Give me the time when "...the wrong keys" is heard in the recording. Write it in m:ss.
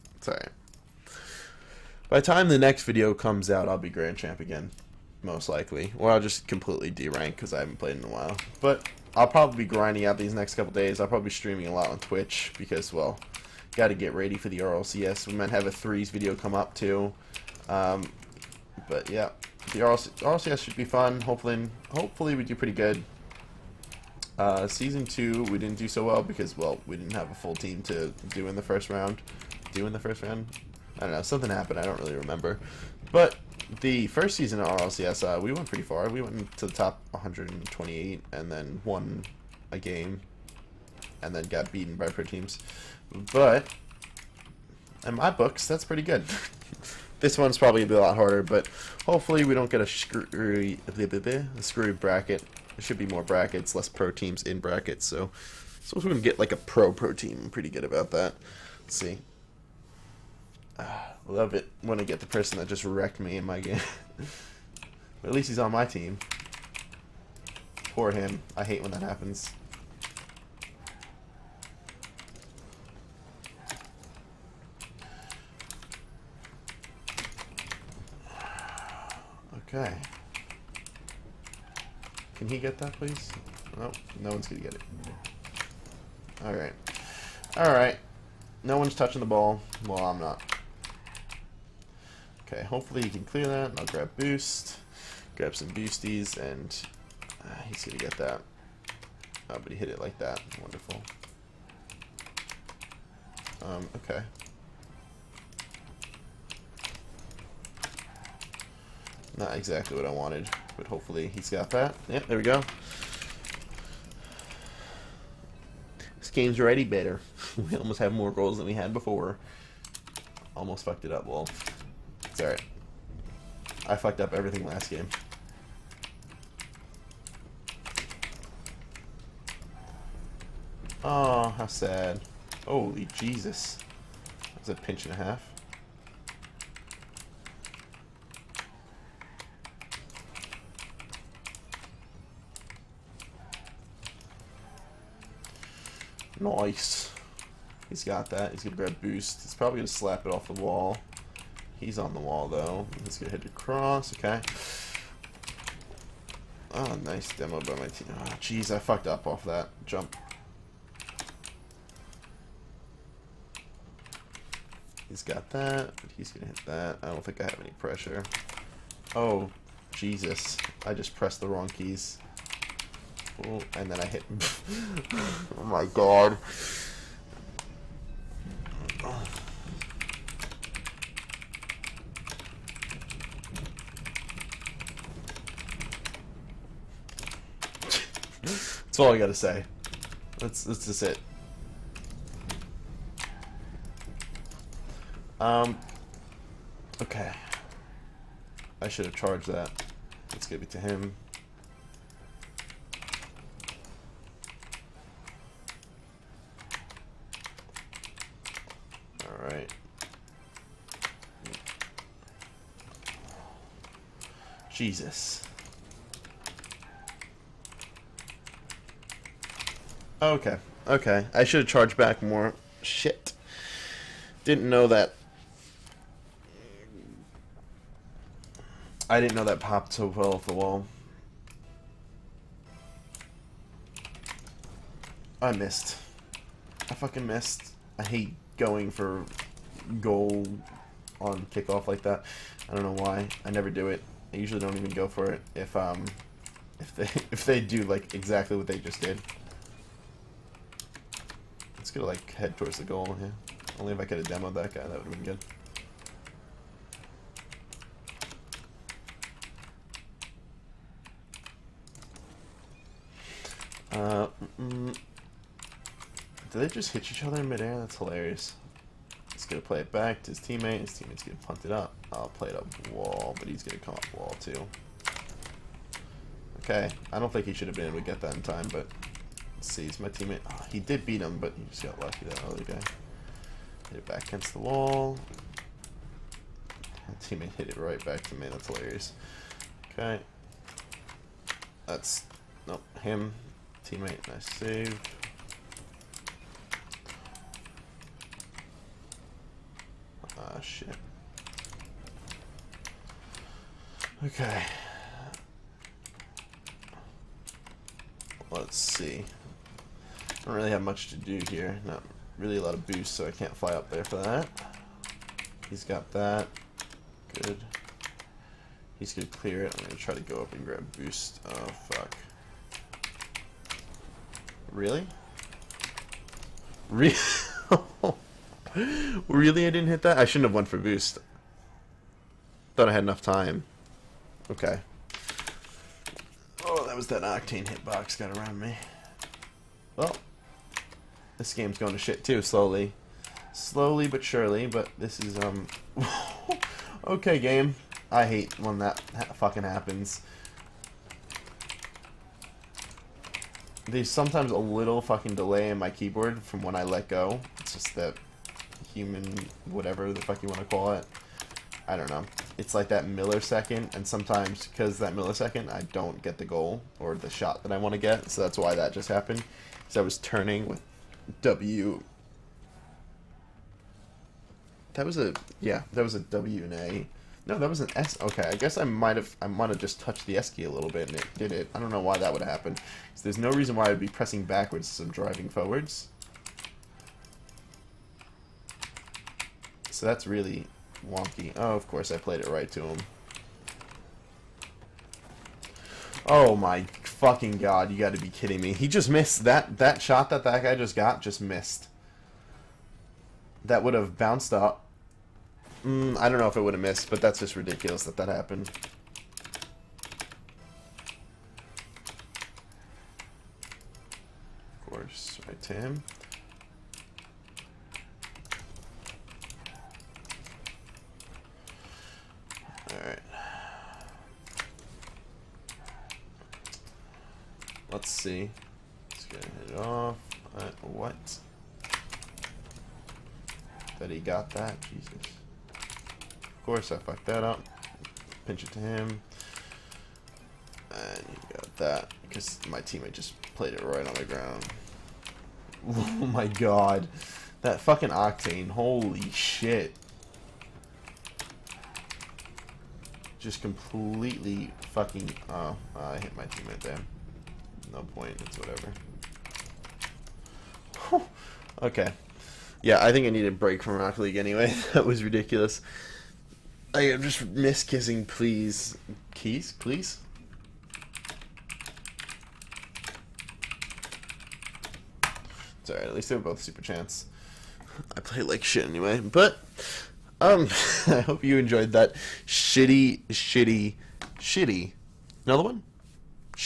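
2:51.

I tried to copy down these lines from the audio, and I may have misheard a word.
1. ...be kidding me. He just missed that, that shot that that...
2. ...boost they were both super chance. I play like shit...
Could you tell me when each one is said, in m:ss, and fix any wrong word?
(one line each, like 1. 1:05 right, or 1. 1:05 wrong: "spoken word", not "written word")
1. 6:38 right
2. 7:56 wrong: "least", not "boost".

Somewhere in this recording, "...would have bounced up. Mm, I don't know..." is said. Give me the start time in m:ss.
6:43.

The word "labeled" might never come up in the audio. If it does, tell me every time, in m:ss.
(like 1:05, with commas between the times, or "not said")
not said.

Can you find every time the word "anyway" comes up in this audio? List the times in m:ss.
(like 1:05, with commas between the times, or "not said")
7:44, 7:58.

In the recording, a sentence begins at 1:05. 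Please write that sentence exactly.
but at least he's on my team.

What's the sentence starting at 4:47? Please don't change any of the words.
My teammate hit it right back to me.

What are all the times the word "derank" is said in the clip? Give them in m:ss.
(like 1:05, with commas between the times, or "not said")
0:06.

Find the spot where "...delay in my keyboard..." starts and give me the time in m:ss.
5:55.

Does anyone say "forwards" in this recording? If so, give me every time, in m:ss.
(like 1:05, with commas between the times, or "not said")
6:25.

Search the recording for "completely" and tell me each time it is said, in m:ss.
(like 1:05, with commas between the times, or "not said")
0:06, 7:33.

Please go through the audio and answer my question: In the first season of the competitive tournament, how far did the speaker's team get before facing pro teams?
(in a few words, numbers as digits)
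Top 128.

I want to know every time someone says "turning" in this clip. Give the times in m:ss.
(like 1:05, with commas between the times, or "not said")
6:10.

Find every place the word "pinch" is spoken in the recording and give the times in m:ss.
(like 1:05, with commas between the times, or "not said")
2:14, 7:18.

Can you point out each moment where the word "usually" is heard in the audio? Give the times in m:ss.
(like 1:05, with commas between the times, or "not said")
4:04.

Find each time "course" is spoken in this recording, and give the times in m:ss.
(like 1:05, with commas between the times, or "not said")
6:31, 6:54, 7:16.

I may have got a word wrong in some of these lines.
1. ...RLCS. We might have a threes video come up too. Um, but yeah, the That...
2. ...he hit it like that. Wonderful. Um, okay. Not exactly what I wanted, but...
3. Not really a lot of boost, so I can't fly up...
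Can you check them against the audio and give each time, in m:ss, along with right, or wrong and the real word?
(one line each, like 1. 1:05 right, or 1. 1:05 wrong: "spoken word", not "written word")
1. 0:14 wrong: "RLC", not "That"
2. 1:39 right
3. 5:11 right.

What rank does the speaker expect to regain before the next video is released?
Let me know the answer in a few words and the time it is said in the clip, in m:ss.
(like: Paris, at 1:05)
Grand Champ, at 0:03.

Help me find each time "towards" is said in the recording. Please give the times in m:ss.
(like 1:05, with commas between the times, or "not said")
4:12.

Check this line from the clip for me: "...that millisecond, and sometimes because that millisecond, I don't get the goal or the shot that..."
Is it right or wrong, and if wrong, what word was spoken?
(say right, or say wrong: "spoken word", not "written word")
right.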